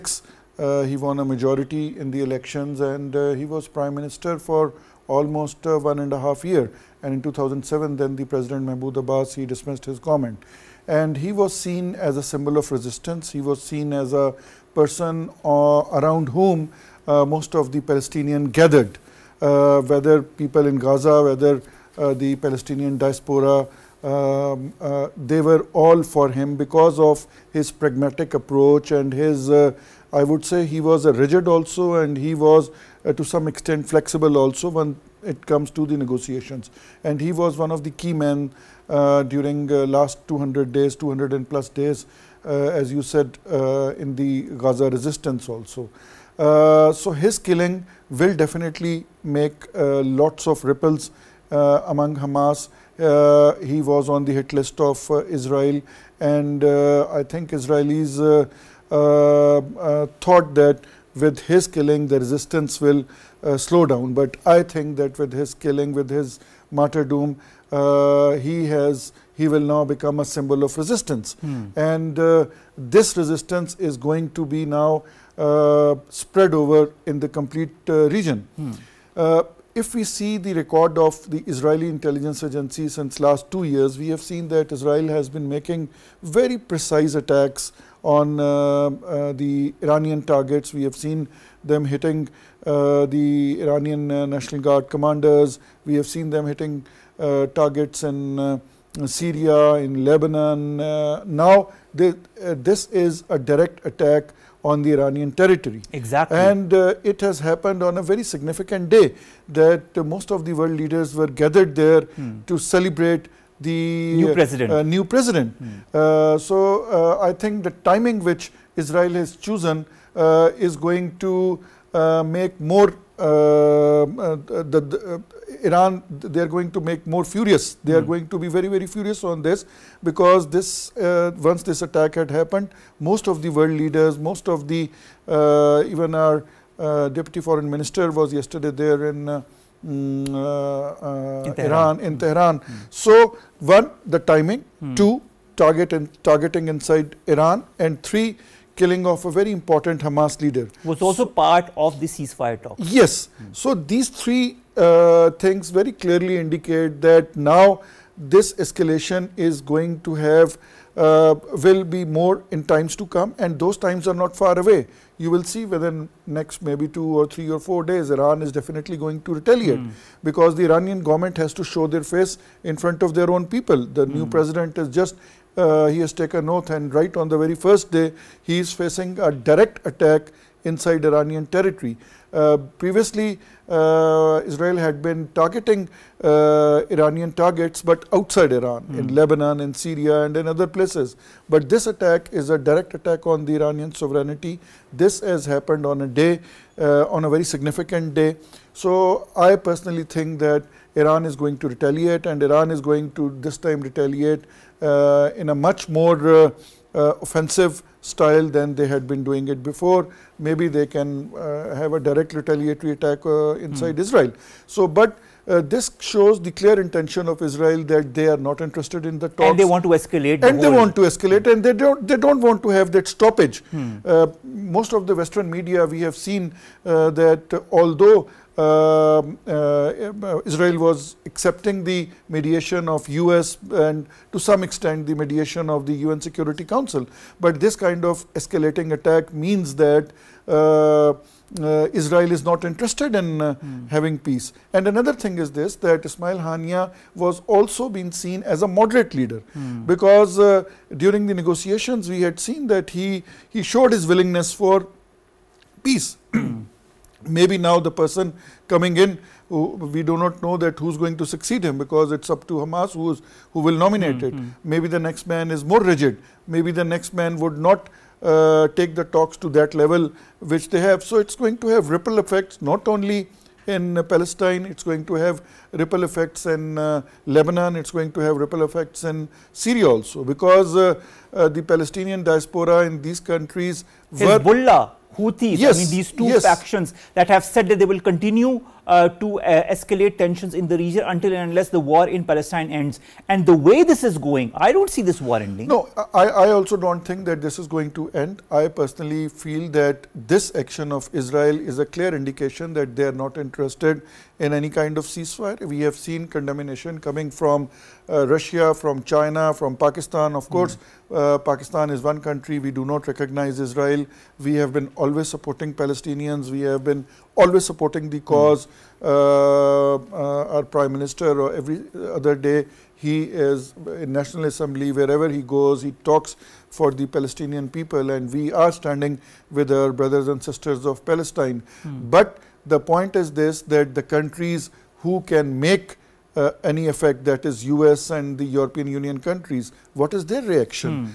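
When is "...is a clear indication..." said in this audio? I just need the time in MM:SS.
05:01.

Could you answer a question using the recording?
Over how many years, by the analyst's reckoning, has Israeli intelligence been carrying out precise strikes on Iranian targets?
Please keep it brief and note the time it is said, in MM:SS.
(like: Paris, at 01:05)
2 years, at 01:23.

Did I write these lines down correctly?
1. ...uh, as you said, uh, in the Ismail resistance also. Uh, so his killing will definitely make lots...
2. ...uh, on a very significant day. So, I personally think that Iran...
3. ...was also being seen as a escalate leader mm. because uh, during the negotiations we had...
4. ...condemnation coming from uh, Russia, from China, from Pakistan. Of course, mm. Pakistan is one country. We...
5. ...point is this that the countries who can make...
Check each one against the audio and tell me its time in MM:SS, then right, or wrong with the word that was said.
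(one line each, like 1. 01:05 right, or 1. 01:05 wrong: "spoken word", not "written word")
1. 00:42 wrong: "Gaza", not "Ismail"
2. 03:16 right
3. 04:07 wrong: "moderate", not "escalate"
4. 05:06 right
5. 05:32 right.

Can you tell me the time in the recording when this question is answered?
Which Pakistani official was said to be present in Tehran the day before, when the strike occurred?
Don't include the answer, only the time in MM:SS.
02:17.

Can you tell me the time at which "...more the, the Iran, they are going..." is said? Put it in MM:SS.
02:02.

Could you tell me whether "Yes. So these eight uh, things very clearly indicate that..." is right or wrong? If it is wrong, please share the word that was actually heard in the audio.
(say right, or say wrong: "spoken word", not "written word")
wrong: "three", not "eight".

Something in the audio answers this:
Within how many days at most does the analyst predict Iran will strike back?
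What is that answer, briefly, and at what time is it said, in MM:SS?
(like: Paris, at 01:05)
4 days, at 02:47.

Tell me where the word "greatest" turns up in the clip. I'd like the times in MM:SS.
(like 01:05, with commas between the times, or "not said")
not said.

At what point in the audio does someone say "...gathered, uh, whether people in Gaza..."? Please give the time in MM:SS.
00:18.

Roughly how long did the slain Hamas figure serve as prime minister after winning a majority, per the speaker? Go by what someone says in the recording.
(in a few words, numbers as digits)
almost one and a half year.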